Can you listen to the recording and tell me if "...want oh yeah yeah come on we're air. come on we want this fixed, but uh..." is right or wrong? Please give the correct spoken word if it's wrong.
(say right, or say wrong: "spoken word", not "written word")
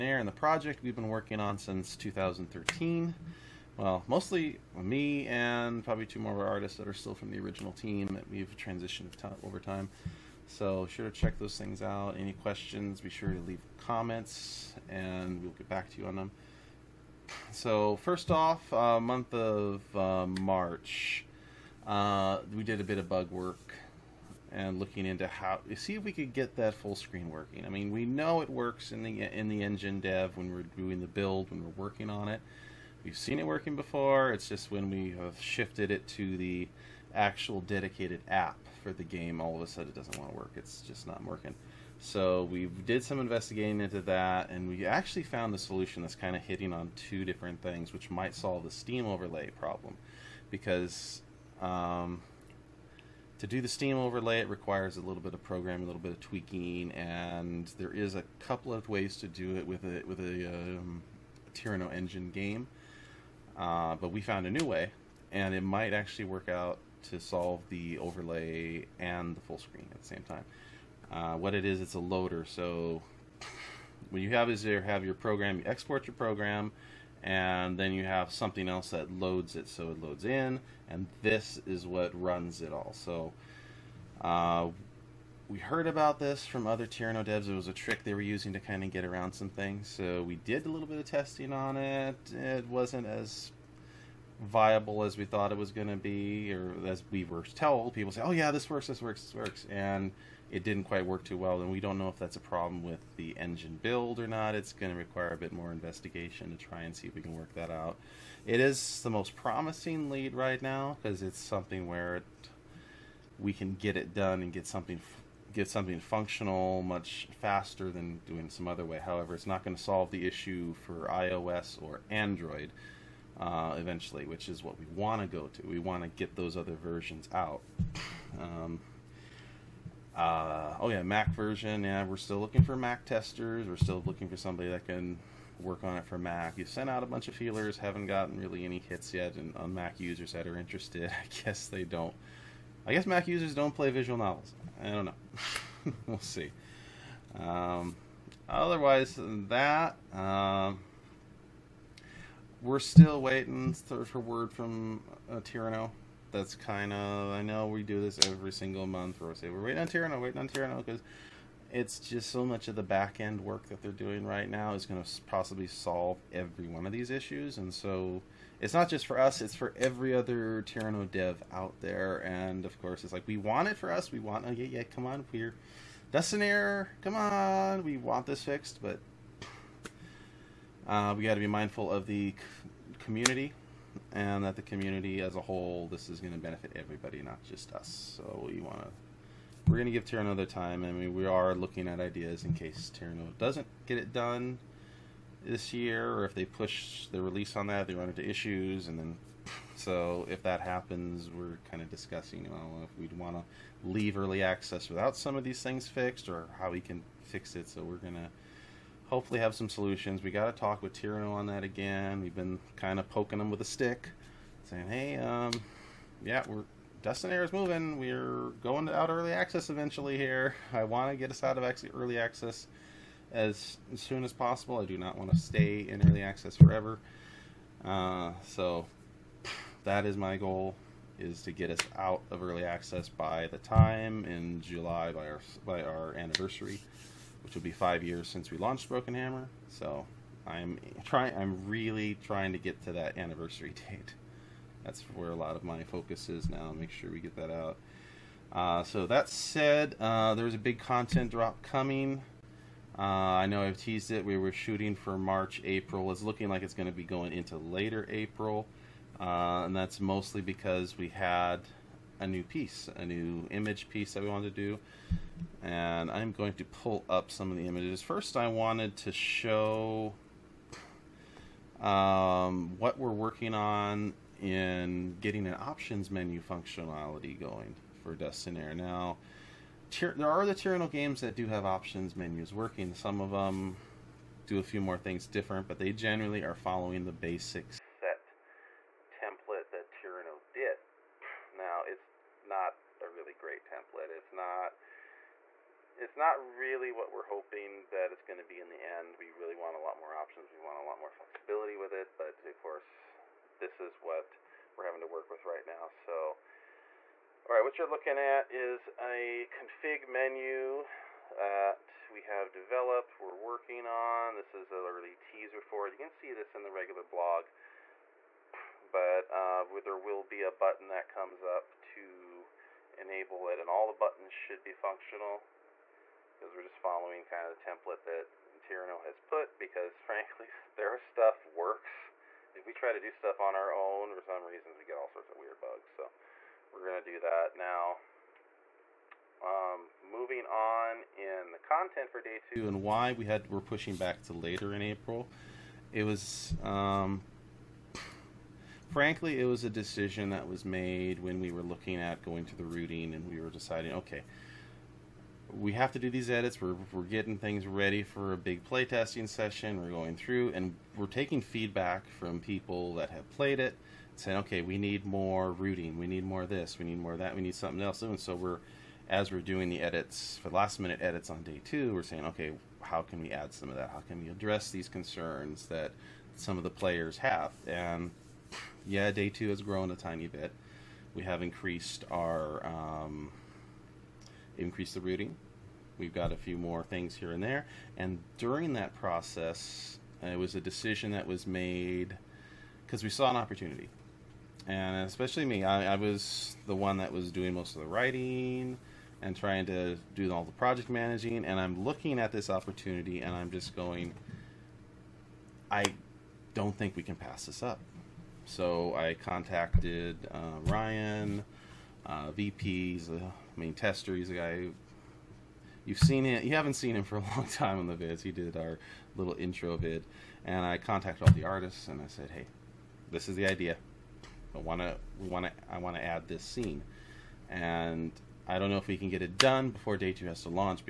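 right.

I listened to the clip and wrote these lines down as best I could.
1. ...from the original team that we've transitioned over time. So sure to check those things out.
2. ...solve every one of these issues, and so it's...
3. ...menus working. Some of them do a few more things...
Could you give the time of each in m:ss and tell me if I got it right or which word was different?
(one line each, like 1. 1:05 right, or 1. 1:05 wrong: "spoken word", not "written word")
1. 0:07 right
2. 2:45 right
3. 4:42 right.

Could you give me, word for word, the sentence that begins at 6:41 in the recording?
And I'm looking at this opportunity and I'm just going, I don't think we can pass this up.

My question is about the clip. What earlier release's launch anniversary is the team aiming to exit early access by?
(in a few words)
Broken Hammer.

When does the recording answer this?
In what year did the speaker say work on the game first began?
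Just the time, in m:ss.
0:01.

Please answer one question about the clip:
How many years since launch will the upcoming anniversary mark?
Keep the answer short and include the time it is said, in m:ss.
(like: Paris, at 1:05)
5, at 3:57.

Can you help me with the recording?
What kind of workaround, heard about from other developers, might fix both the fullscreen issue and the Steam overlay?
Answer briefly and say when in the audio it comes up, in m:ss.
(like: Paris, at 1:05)
A loader, at 1:11.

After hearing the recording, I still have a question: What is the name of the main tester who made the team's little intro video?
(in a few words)
Ryan.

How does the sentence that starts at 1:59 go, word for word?
However, it's not going to solve the issue for iOS or Android uh, eventually, which is what we want to go to.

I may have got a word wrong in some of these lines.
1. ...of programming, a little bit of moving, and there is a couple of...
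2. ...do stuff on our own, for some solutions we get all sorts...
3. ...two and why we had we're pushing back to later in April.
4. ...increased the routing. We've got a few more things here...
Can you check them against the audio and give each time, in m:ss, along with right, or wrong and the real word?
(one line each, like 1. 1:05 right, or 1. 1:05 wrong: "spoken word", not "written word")
1. 0:55 wrong: "tweaking", not "moving"
2. 5:32 wrong: "reasons", not "solutions"
3. 5:42 right
4. 6:24 right.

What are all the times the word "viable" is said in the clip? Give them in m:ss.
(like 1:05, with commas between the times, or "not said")
1:34.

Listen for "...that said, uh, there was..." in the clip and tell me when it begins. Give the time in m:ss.
4:09.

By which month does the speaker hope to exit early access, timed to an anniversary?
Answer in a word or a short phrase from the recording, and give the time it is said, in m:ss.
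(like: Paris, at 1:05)
July, at 3:54.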